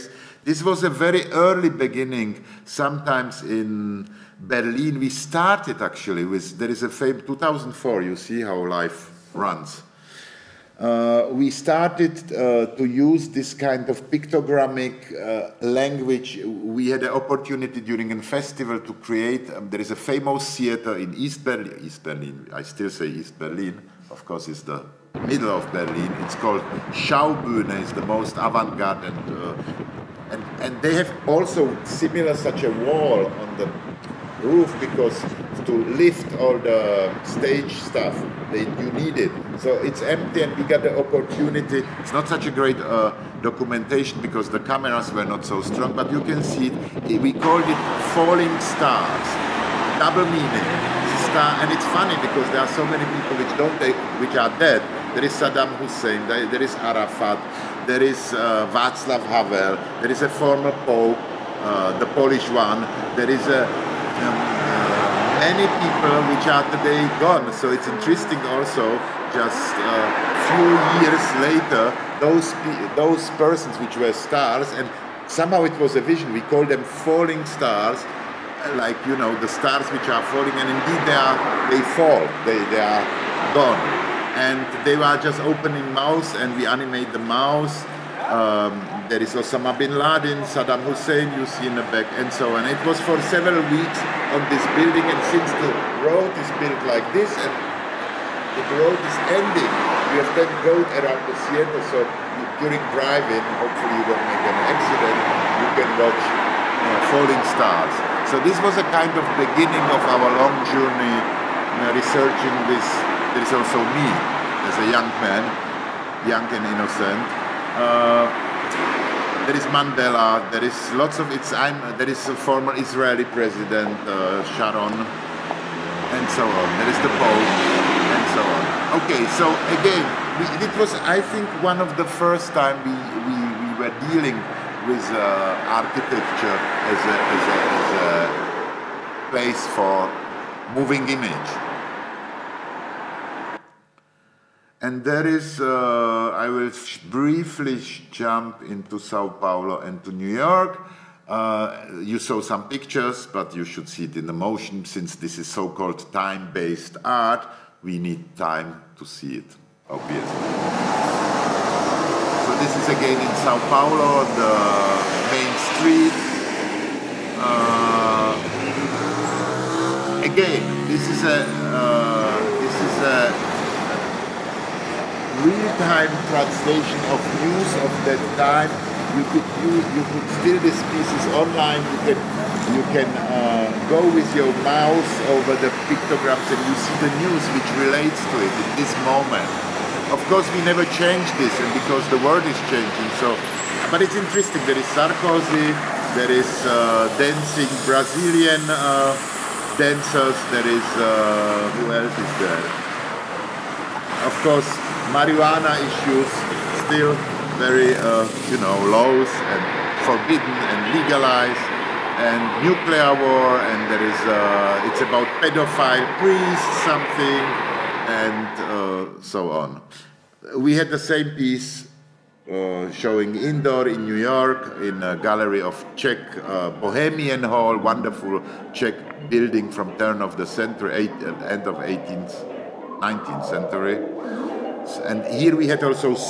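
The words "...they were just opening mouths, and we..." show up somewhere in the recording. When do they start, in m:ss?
1:24.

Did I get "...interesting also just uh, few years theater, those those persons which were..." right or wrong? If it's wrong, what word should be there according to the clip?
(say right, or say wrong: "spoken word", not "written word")
wrong: "later", not "theater".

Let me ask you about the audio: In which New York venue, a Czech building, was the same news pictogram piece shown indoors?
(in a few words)
Bohemian Hall.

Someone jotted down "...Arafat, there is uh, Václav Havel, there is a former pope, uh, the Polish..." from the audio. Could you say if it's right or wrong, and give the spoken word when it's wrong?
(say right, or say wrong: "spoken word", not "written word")
right.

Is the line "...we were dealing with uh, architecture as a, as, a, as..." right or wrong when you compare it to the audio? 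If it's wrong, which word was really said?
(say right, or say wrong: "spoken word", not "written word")
right.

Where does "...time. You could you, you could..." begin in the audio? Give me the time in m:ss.
2:58.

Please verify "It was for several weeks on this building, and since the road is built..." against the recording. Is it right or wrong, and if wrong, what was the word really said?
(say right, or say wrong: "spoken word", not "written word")
right.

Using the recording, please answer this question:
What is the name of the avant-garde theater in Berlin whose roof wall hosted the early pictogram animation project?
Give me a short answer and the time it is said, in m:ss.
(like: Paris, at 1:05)
Schaubühne, at 0:26.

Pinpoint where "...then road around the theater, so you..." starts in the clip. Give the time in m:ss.
1:40.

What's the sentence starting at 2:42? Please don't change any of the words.
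So this is again in Sao Paulo, the main street.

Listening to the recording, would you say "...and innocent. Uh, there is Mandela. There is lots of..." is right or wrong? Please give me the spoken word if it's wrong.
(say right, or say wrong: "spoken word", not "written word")
right.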